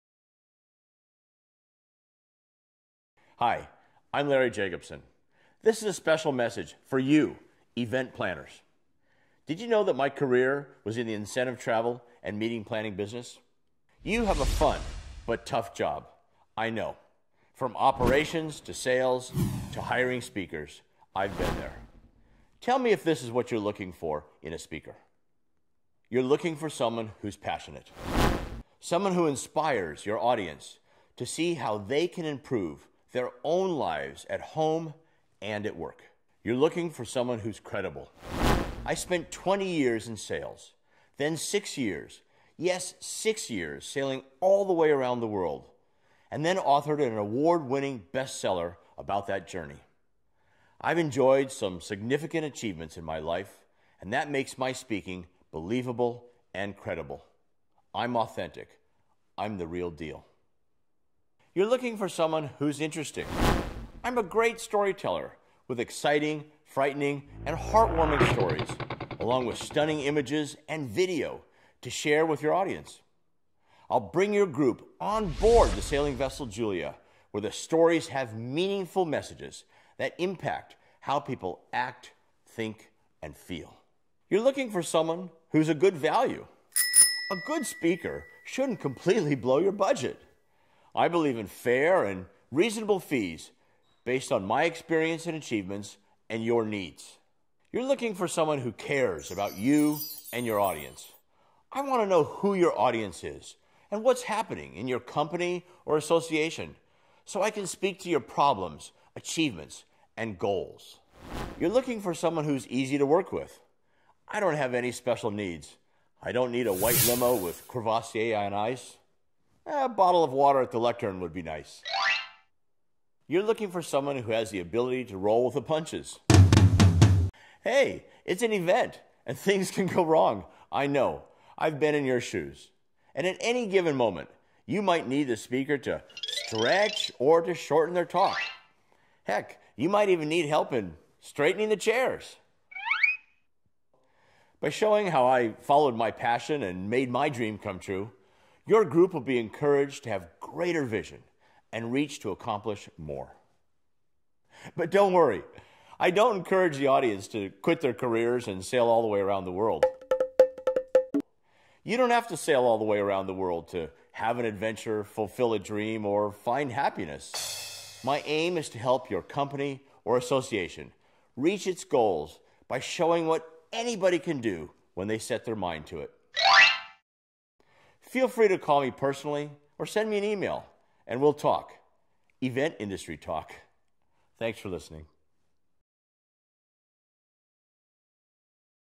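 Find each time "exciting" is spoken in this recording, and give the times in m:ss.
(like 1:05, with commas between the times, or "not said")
1:05.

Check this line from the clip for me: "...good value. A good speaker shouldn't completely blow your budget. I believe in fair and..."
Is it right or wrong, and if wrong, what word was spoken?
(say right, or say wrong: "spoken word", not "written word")
right.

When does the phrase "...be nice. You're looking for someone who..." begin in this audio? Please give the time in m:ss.
2:01.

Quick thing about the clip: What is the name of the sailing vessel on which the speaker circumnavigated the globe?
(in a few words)
Julia.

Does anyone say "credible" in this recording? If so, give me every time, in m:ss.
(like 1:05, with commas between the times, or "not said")
0:37, 0:56.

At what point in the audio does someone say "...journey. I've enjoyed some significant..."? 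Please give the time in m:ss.
0:49.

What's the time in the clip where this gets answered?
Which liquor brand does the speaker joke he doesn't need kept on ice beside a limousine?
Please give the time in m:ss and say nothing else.
1:57.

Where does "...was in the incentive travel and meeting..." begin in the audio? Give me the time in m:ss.
0:10.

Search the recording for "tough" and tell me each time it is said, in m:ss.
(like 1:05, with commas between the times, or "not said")
0:15.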